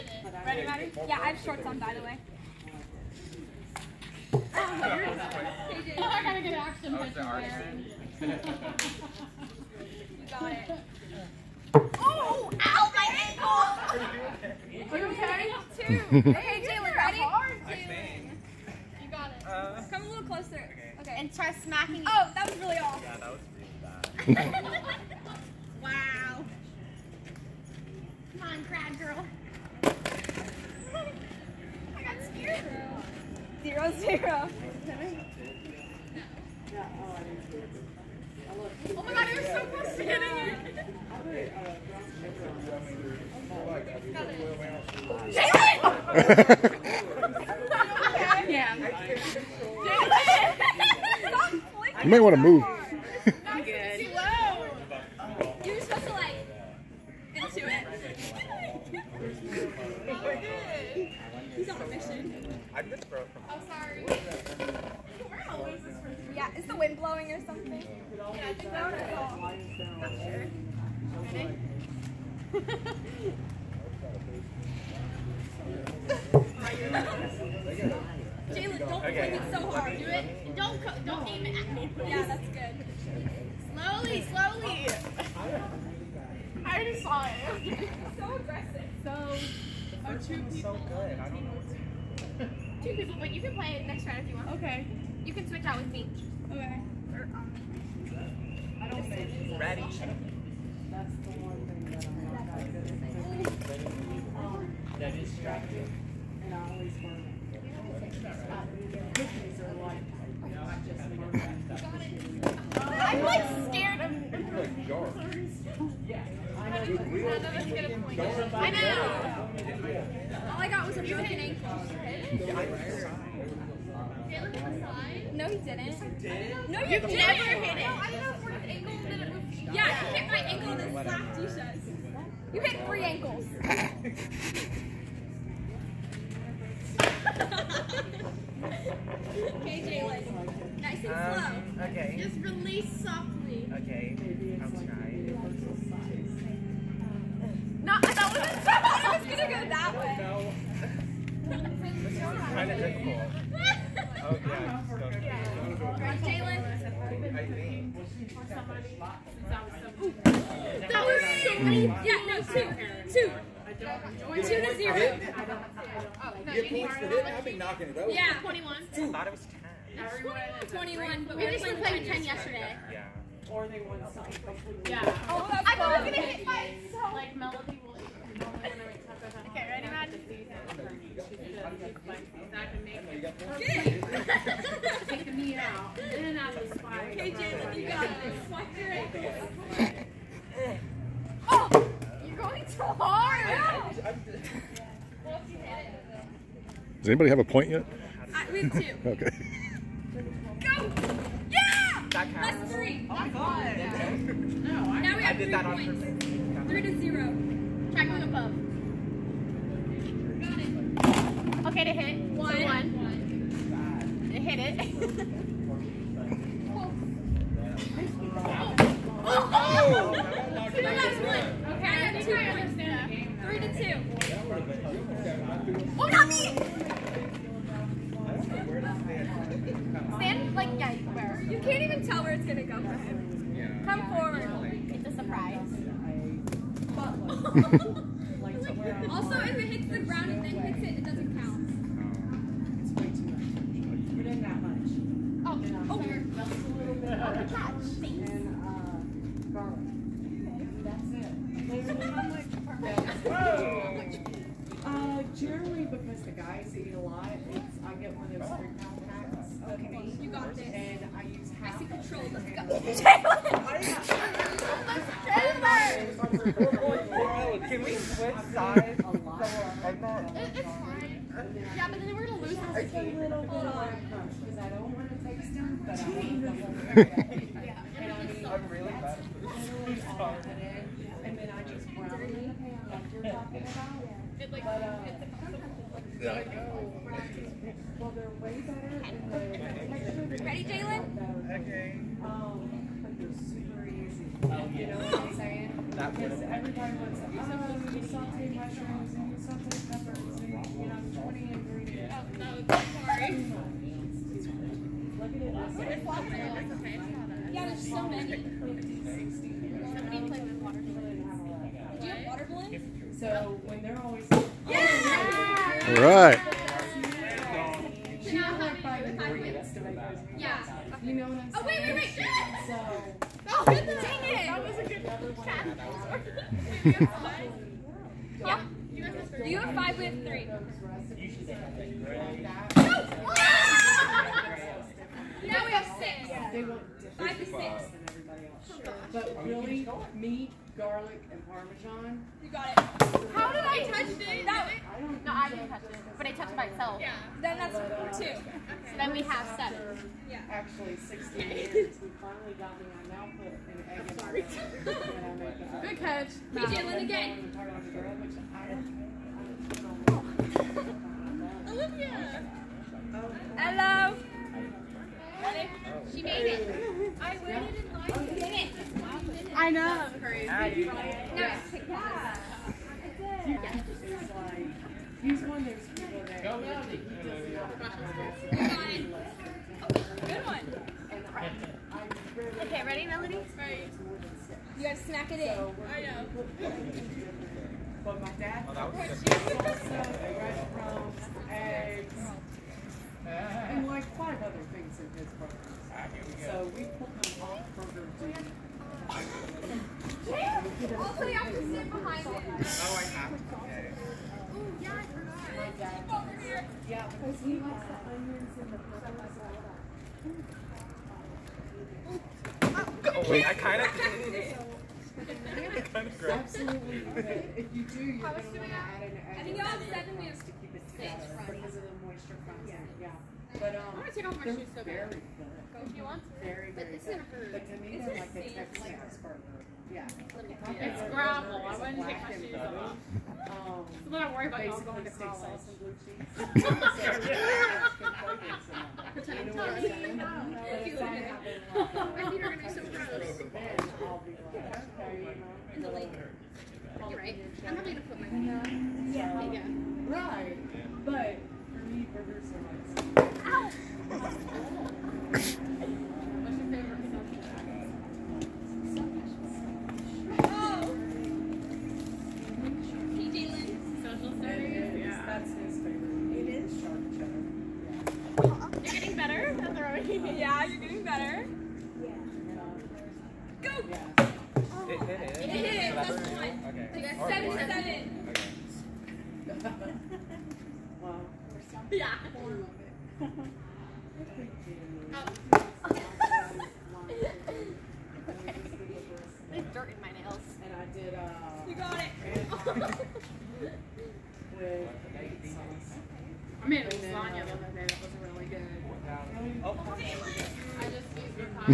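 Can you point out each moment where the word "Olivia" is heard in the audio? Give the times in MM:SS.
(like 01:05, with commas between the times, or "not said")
06:01.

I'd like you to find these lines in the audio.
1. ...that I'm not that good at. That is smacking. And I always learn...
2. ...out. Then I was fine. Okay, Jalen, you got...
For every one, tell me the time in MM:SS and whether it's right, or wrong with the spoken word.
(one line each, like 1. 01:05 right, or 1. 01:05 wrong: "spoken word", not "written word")
1. 01:41 wrong: "distracting", not "smacking"
2. 03:05 right.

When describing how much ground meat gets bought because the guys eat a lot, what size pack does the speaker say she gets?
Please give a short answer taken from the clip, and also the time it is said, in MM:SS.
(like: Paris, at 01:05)
3 pound, at 04:18.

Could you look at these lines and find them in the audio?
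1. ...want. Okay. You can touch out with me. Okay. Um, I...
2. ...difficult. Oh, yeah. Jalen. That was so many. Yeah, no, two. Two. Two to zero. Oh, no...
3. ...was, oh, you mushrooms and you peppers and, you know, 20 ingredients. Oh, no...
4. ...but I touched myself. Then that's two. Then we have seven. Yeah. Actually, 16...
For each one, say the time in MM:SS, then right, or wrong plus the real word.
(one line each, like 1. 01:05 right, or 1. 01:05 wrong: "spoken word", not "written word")
1. 01:34 wrong: "switch", not "touch"
2. 02:33 right
3. 04:56 right
4. 05:46 right.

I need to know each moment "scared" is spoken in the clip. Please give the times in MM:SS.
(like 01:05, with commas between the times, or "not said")
00:32, 01:53.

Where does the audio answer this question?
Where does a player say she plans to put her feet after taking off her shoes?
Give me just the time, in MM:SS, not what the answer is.
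07:25.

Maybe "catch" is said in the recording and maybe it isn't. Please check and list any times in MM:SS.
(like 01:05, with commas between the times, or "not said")
05:55.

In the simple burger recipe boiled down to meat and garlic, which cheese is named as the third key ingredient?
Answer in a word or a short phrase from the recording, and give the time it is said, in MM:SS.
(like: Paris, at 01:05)
Parmesan, at 05:41.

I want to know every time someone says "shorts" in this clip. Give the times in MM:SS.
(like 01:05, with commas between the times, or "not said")
00:01.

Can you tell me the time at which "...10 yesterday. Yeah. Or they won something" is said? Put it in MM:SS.
02:52.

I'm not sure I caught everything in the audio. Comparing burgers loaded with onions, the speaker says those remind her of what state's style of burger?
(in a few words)
Texas.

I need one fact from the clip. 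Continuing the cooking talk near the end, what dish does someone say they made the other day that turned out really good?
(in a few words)
Lasagna.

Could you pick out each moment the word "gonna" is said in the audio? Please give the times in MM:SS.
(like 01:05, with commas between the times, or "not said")
03:52, 07:04.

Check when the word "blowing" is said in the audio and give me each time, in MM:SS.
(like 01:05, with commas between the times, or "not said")
01:06.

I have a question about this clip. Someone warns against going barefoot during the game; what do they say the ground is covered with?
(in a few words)
Gravel.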